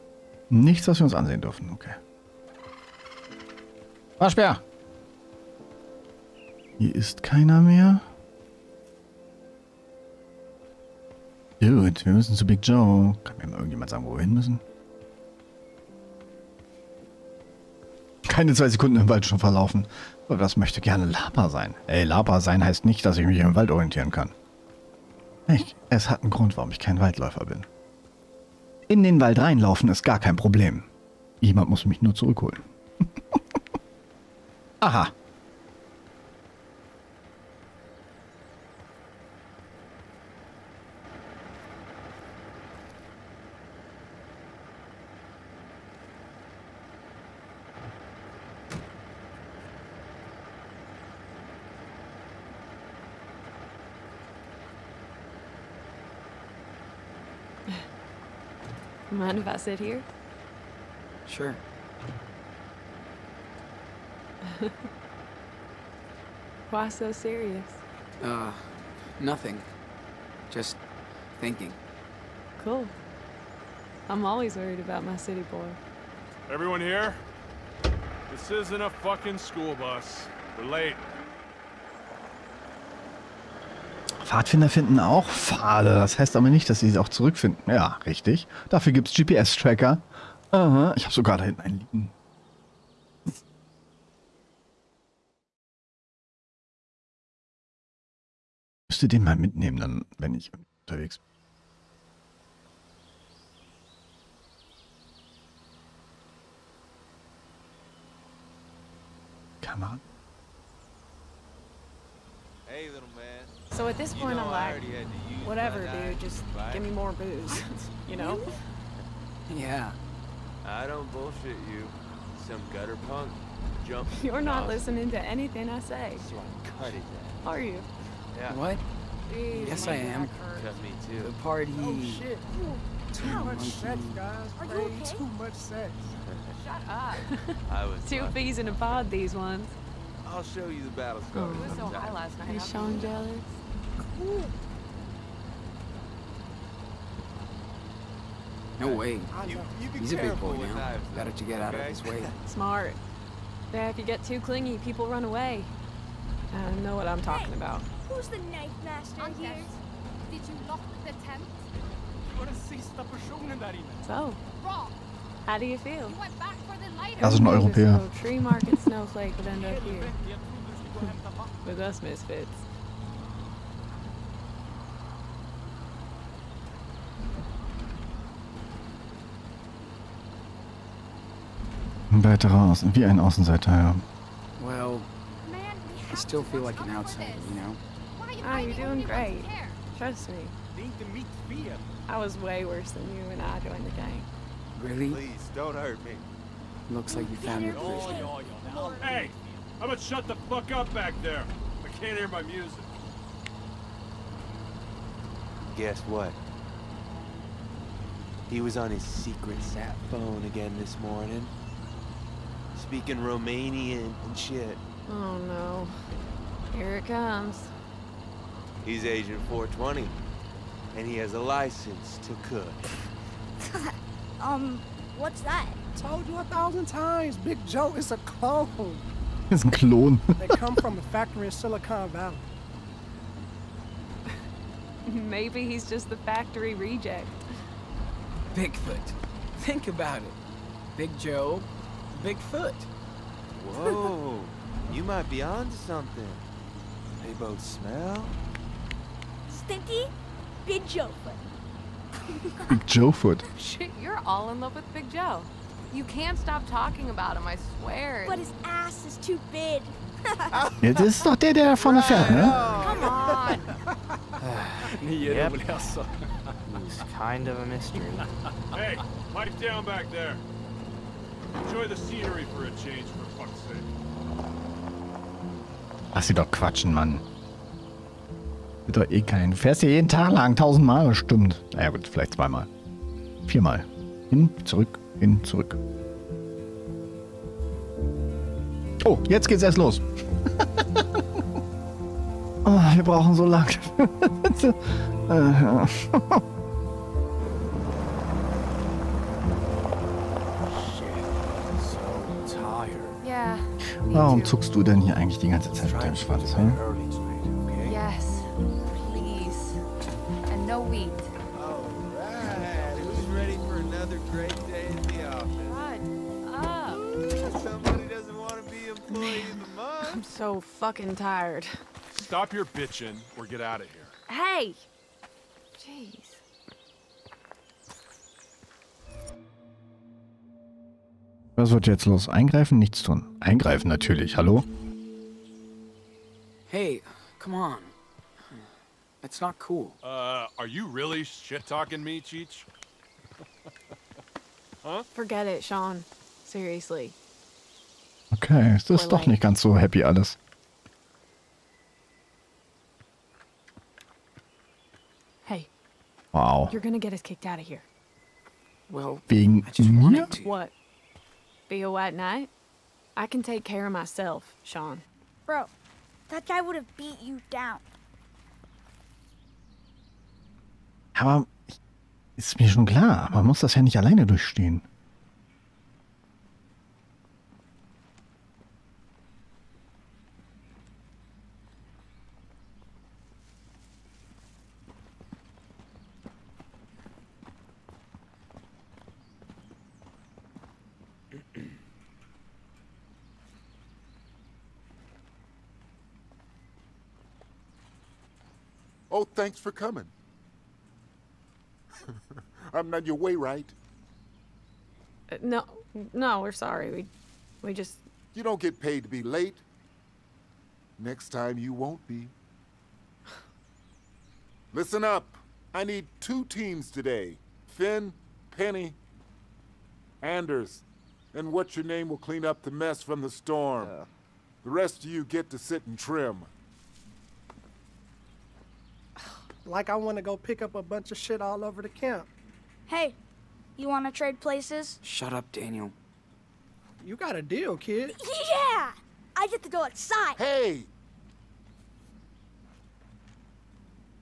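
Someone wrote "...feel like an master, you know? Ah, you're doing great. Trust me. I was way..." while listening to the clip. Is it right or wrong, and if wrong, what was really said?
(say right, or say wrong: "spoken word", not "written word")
wrong: "outsider", not "master".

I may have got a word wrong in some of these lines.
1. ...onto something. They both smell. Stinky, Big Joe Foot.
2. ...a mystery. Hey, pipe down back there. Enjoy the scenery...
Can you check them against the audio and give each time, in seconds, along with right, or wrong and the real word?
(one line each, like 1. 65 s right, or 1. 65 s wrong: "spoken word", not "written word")
1. 245 s right
2. 267 s right.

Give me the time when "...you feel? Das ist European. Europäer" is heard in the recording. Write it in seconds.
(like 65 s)
165 s.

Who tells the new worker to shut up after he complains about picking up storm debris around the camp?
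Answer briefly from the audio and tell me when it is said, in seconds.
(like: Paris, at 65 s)
Daniel, at 435 s.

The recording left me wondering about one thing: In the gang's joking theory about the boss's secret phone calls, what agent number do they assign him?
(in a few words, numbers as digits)
420.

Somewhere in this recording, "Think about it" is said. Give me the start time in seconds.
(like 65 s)
239 s.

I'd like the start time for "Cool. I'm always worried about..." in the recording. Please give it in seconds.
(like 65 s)
72 s.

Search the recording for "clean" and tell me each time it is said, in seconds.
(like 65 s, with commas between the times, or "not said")
422 s.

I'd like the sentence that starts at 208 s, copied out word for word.
He was on his secret sat phone again this morning speaking Romanian and shit.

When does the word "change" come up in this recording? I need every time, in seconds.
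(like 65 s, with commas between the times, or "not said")
272 s.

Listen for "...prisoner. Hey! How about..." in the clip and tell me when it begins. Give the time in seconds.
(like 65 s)
197 s.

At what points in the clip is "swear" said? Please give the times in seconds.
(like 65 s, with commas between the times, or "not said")
257 s.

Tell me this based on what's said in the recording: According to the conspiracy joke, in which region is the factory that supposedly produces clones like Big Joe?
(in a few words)
Silicon Valley.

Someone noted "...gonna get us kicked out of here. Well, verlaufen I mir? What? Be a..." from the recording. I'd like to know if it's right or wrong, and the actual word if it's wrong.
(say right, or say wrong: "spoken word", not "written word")
wrong: "wegen", not "verlaufen".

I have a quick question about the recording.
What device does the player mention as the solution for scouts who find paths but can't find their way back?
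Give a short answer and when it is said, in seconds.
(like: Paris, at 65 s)
GPS-Tracker, at 89 s.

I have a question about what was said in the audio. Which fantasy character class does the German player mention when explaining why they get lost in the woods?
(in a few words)
Waldläufer.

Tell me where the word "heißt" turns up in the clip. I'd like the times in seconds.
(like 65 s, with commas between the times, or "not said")
22 s, 86 s.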